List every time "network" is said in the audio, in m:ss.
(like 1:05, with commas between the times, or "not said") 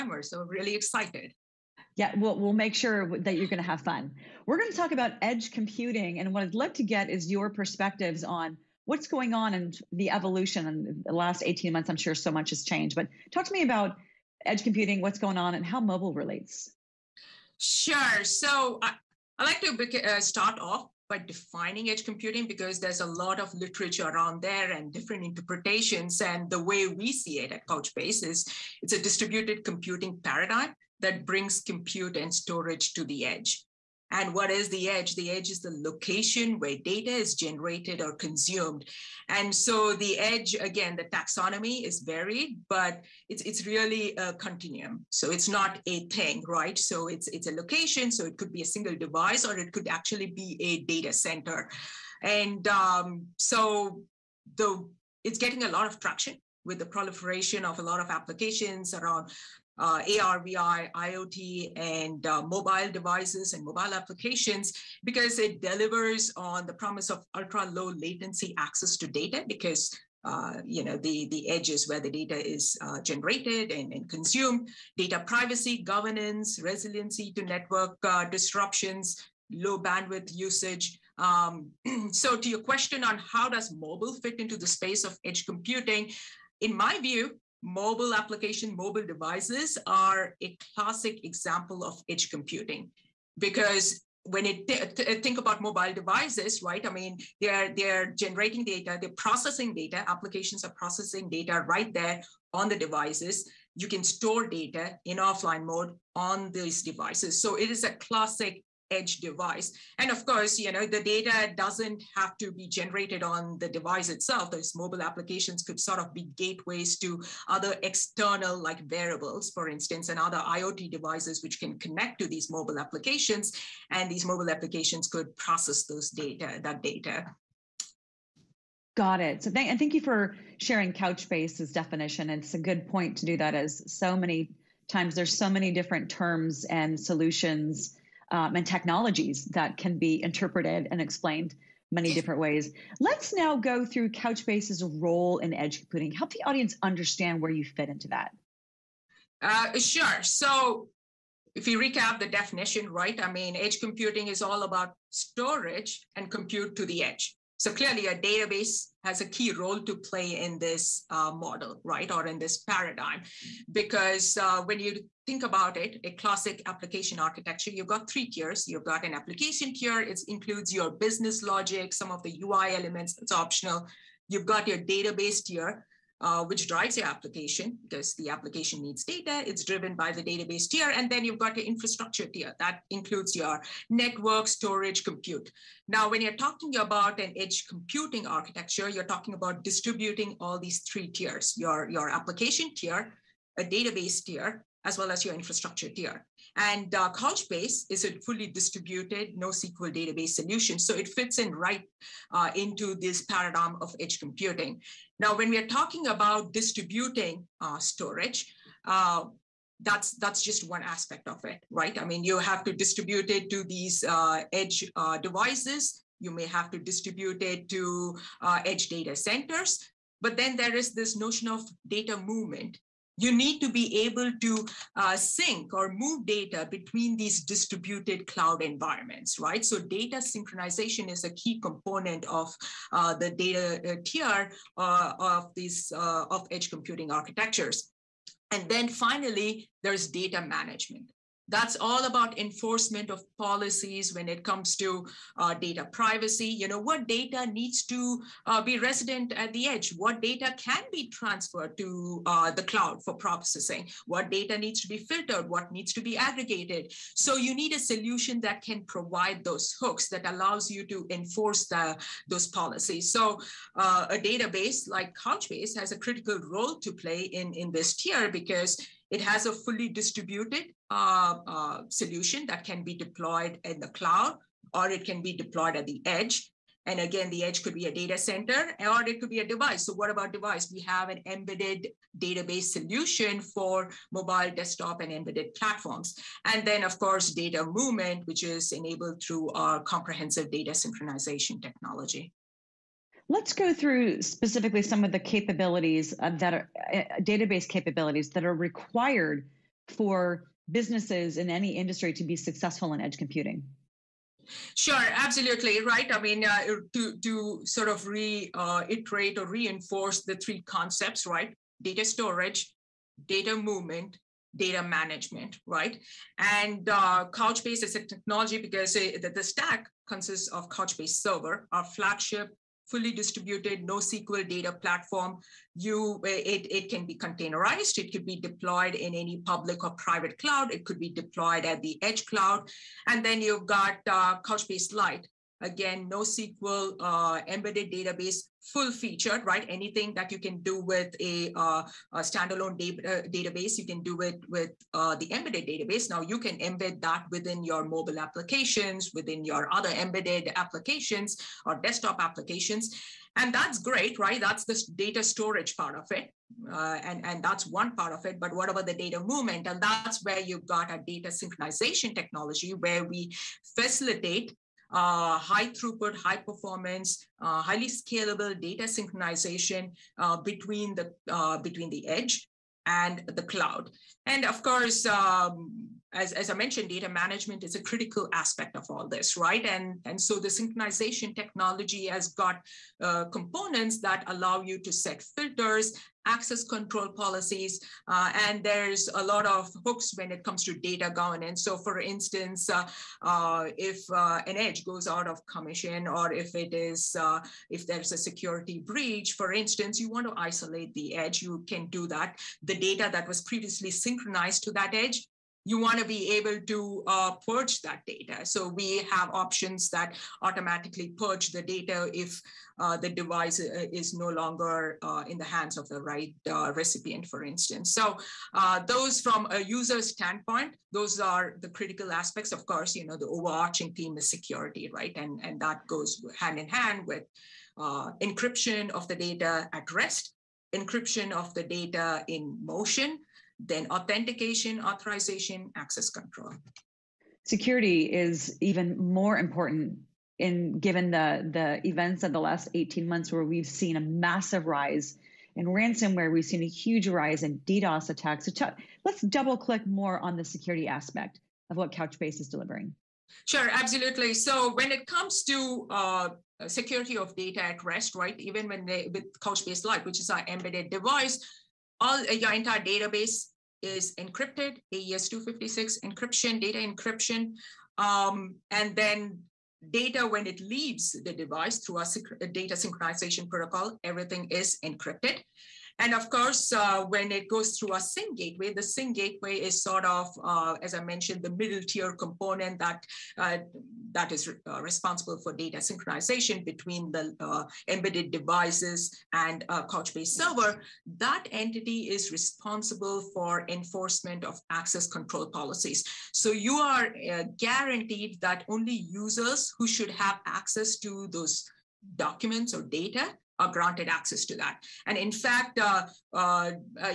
1:17, 3:03.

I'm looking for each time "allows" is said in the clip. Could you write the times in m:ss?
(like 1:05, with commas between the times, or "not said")
4:20, 6:24.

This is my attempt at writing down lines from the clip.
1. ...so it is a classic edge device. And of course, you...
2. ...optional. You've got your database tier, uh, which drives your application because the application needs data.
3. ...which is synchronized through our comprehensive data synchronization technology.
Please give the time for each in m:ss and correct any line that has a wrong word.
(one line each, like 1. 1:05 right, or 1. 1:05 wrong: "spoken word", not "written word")
1. 1:47 right
2. 2:53 right
3. 4:48 wrong: "enabled", not "synchronized".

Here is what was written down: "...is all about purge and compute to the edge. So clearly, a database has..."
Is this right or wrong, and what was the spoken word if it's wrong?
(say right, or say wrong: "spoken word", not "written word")
wrong: "storage", not "purge".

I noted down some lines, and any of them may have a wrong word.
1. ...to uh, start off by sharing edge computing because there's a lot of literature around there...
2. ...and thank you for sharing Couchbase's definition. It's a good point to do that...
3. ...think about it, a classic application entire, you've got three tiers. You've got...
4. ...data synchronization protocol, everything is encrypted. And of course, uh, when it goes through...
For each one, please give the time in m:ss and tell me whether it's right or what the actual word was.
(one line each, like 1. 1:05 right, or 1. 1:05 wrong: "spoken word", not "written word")
1. 0:19 wrong: "defining", not "sharing"
2. 2:09 right
3. 2:45 wrong: "architecture", not "entire"
4. 7:52 right.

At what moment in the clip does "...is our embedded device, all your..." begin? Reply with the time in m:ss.
7:40.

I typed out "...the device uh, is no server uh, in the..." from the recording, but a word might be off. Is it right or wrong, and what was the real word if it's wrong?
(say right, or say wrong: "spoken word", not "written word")
wrong: "longer", not "server".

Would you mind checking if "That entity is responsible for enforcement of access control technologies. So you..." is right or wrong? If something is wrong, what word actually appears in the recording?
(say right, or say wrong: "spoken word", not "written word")
wrong: "policies", not "technologies".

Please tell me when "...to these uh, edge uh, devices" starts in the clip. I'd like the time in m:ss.
3:33.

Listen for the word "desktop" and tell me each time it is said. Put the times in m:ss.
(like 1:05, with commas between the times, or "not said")
4:44, 5:51.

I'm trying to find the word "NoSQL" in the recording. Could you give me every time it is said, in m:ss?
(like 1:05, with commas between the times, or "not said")
3:19, 5:23, 5:36.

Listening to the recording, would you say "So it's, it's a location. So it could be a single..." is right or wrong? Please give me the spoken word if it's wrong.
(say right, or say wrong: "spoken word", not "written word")
right.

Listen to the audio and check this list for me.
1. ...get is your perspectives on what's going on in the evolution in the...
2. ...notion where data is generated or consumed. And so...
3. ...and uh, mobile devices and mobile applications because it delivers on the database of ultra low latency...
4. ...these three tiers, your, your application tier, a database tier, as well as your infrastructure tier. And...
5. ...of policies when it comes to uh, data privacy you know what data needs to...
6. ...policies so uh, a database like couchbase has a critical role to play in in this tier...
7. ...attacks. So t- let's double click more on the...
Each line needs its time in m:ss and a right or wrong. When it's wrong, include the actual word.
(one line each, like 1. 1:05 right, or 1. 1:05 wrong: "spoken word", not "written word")
1. 0:06 right
2. 0:35 wrong: "location", not "notion"
3. 1:01 wrong: "promise", not "database"
4. 3:10 right
5. 4:03 right
6. 4:22 right
7. 7:28 right.